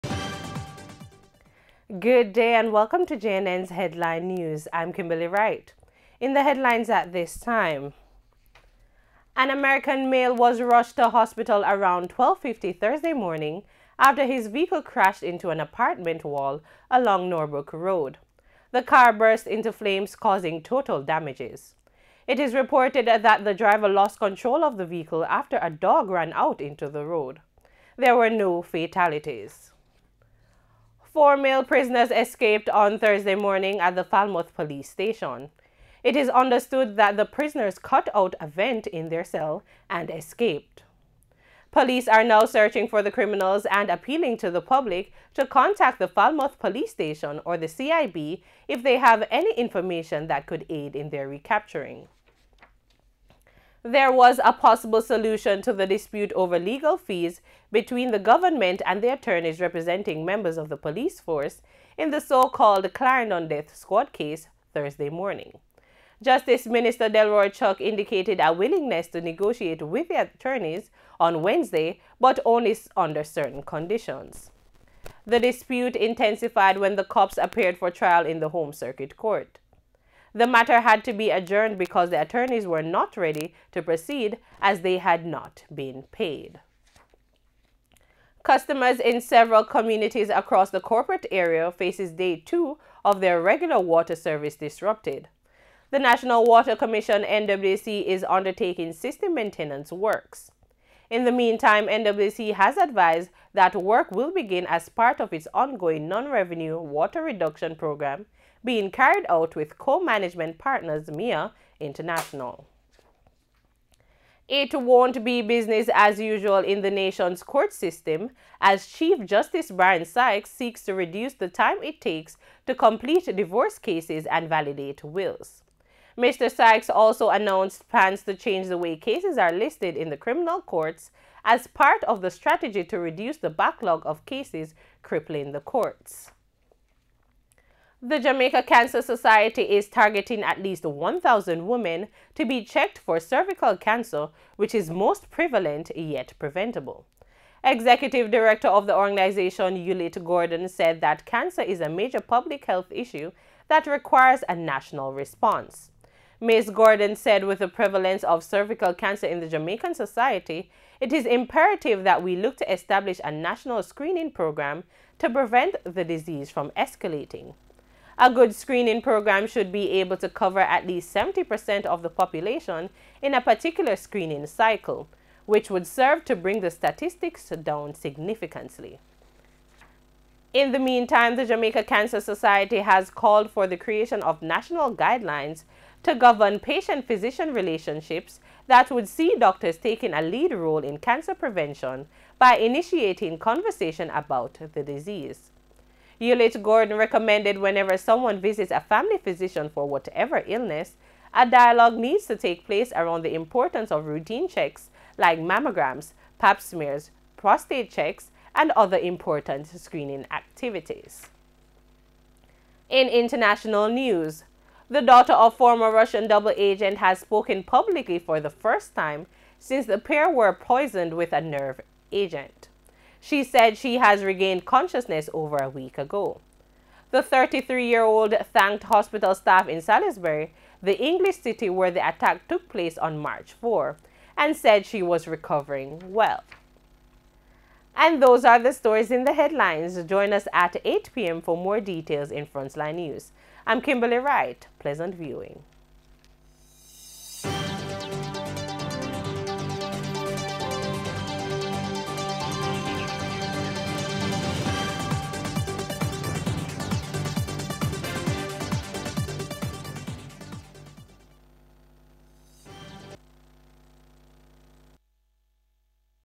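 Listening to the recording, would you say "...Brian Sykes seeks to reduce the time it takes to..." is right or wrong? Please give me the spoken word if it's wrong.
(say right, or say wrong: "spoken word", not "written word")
right.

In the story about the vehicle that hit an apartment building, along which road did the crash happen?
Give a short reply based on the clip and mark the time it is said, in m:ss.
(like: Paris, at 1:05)
Norbrook Road, at 0:17.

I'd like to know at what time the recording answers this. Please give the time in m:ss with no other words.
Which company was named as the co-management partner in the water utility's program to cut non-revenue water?
1:51.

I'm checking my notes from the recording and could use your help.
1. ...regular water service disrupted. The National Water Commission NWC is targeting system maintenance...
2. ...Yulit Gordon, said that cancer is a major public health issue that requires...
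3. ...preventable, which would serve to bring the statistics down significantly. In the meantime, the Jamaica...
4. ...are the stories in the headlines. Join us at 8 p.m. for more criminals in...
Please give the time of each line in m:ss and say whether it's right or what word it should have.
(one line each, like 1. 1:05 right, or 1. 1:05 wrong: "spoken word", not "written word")
1. 1:33 wrong: "undertaking", not "targeting"
2. 2:29 right
3. 2:54 wrong: "cycle", not "preventable"
4. 3:58 wrong: "details", not "criminals".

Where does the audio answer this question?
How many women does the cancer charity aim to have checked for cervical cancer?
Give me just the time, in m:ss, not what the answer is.
2:20.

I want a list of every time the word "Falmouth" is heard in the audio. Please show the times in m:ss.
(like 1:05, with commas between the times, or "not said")
0:34, 0:46.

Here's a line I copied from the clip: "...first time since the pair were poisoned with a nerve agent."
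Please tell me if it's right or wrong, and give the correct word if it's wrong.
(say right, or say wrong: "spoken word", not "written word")
right.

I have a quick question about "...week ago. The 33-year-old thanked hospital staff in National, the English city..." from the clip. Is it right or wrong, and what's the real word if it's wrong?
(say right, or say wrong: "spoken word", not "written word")
wrong: "Salisbury", not "National".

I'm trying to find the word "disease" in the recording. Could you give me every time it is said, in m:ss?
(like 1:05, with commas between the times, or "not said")
2:46, 3:14.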